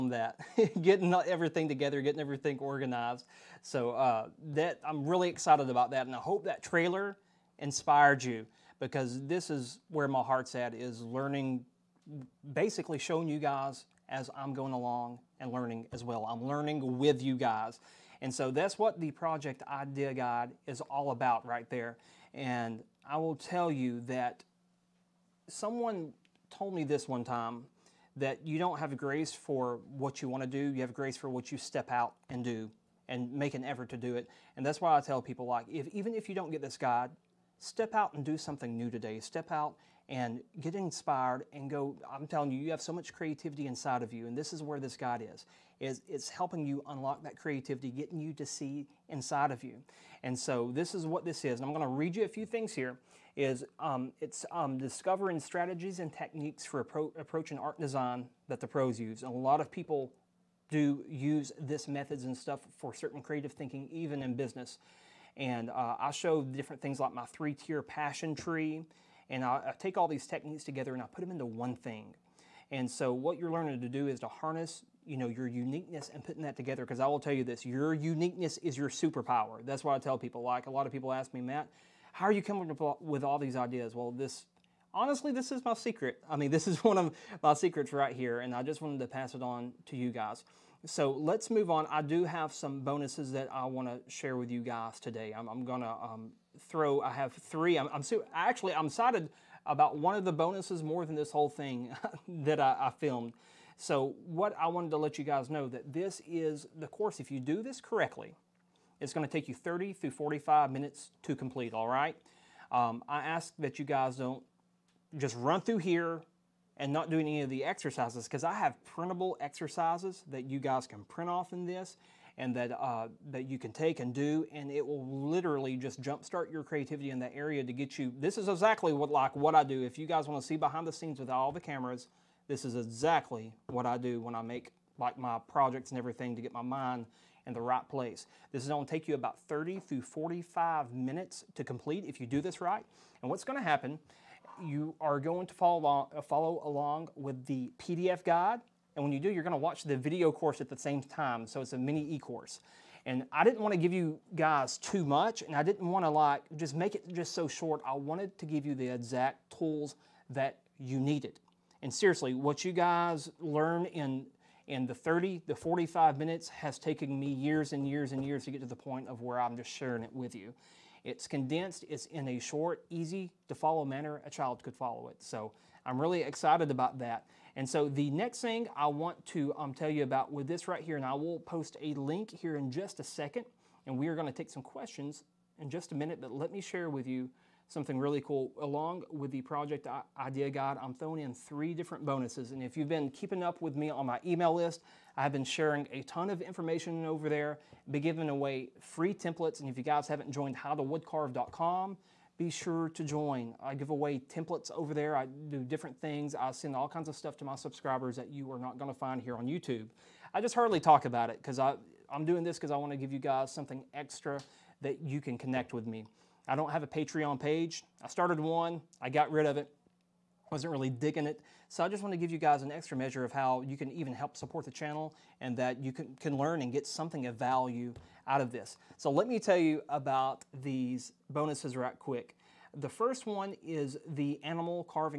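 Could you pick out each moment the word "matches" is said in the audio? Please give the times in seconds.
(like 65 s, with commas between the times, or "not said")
not said.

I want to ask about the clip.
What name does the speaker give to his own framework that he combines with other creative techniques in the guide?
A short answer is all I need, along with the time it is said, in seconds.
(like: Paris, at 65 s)
three-tier passion tree, at 67 s.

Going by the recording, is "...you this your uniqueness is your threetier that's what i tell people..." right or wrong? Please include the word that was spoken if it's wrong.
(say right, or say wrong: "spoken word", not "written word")
wrong: "superpower", not "threetier".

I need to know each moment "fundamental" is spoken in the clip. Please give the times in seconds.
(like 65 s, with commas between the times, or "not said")
not said.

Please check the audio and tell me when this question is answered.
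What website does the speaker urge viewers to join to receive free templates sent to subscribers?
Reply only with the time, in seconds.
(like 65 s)
200 s.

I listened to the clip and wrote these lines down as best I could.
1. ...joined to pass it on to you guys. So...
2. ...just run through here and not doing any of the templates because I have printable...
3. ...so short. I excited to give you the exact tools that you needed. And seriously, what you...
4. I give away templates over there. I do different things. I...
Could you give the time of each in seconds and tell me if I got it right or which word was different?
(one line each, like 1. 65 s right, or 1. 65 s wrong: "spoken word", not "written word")
1. 88 s wrong: "wanted", not "joined"
2. 115 s wrong: "exercises", not "templates"
3. 157 s wrong: "wanted", not "excited"
4. 203 s right.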